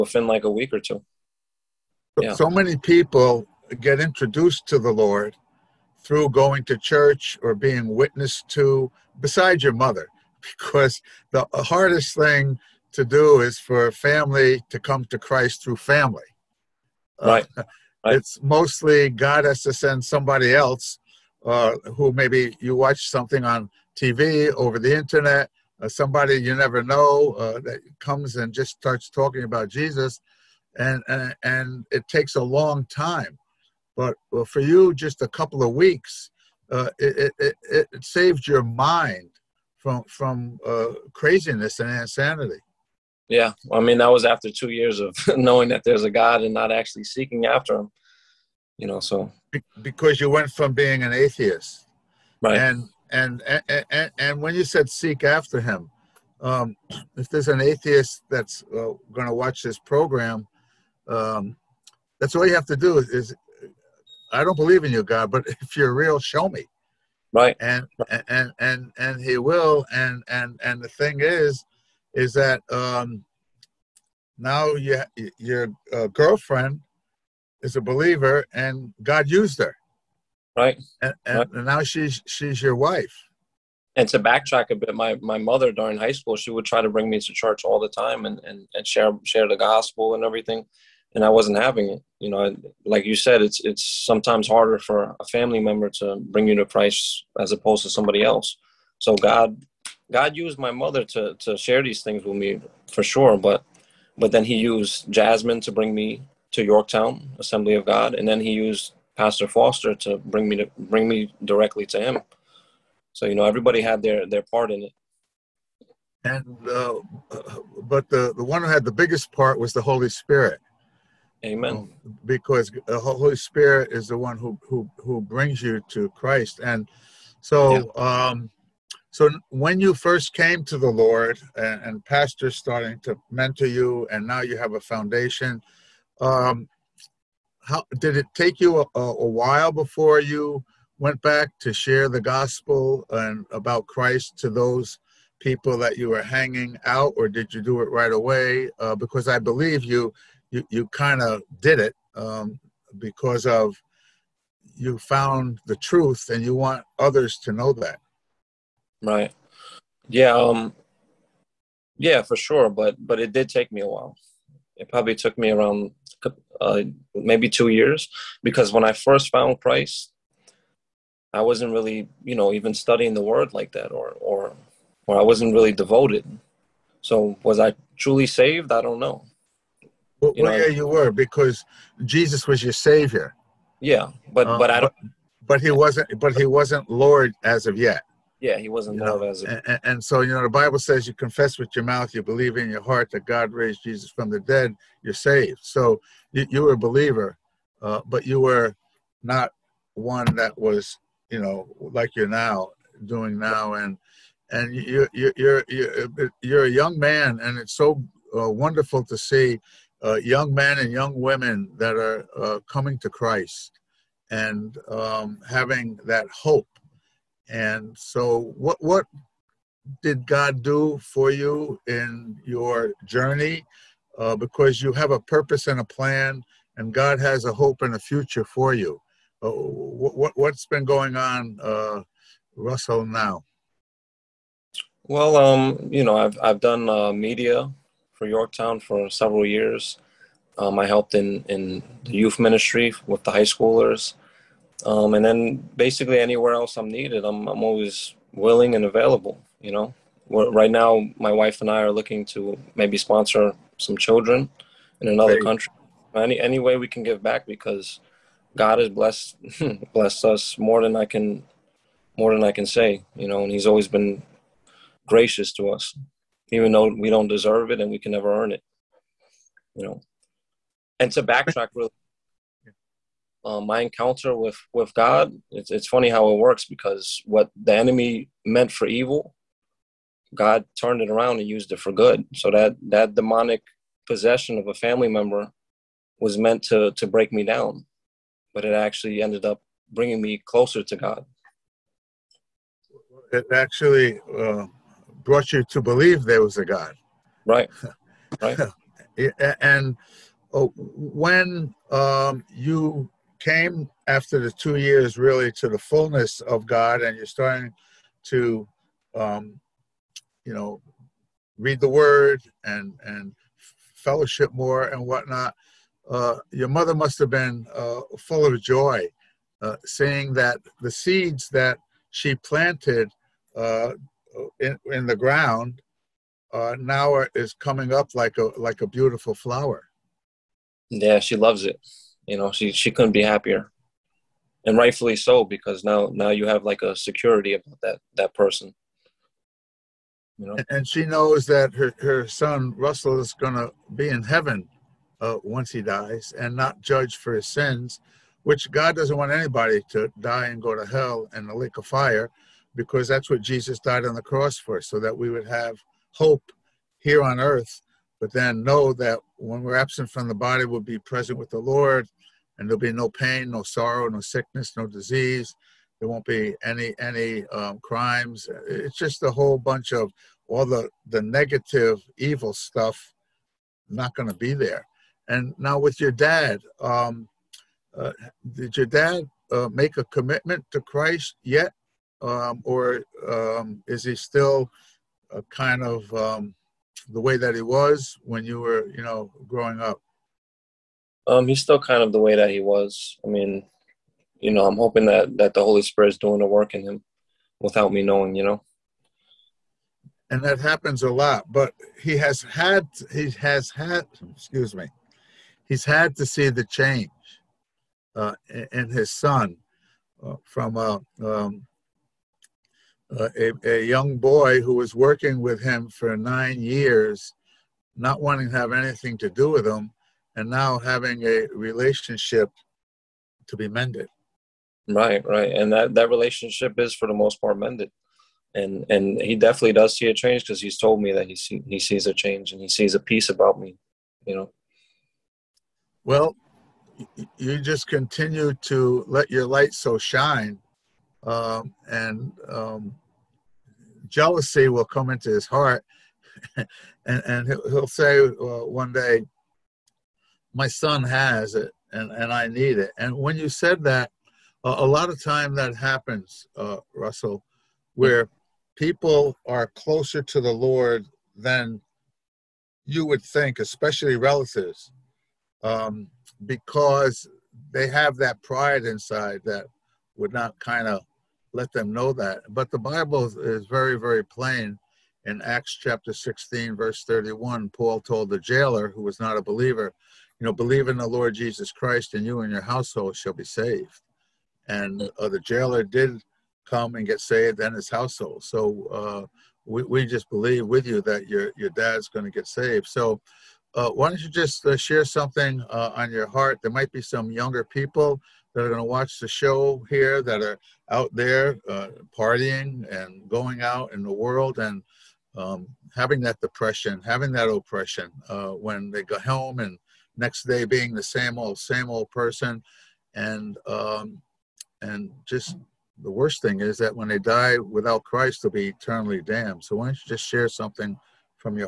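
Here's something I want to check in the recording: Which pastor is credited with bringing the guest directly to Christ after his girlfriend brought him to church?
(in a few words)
Pastor Foster.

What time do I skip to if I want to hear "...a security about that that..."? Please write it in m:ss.
5:36.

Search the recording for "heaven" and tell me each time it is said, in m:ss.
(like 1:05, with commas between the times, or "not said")
5:44.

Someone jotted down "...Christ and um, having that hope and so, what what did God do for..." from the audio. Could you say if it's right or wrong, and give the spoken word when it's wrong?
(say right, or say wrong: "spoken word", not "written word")
right.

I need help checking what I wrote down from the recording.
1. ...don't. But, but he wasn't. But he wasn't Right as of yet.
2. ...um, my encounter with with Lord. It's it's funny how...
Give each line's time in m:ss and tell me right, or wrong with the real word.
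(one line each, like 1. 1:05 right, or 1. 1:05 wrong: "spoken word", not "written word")
1. 3:04 wrong: "Lord", not "Right"
2. 4:33 wrong: "God", not "Lord".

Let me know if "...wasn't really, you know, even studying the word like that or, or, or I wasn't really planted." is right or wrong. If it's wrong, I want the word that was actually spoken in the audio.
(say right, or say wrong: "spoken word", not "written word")
wrong: "devoted", not "planted".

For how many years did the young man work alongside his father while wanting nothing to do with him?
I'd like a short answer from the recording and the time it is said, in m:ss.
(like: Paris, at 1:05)
9, at 6:56.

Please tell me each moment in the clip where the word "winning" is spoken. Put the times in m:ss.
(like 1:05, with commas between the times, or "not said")
not said.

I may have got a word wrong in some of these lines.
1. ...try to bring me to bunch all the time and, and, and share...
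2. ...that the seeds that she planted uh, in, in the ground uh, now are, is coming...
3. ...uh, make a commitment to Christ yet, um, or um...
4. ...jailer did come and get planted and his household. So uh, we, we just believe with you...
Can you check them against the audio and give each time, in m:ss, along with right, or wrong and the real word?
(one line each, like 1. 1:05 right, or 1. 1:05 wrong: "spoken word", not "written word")
1. 1:26 wrong: "church", not "bunch"
2. 5:20 right
3. 6:19 right
4. 8:05 wrong: "saved", not "planted".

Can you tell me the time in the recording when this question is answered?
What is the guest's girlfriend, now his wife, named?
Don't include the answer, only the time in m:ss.
1:45.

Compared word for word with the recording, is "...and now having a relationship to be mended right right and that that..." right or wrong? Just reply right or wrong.
right.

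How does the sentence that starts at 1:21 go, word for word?
and now she's she's your wife.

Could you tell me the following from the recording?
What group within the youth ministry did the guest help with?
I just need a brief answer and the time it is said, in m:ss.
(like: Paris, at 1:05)
High schoolers, at 4:03.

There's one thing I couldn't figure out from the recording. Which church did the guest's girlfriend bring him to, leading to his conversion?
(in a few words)
Yorktown Assembly of God.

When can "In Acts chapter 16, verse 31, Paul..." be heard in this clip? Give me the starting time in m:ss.
7:55.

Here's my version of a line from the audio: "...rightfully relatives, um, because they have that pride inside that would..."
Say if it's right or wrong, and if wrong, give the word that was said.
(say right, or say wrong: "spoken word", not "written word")
wrong: "especially", not "rightfully".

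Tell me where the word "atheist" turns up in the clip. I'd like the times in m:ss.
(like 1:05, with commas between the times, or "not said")
0:51, 0:57.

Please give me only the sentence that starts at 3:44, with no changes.
Uh, because you have a purpose and a plan, and God has a hope and a future for you.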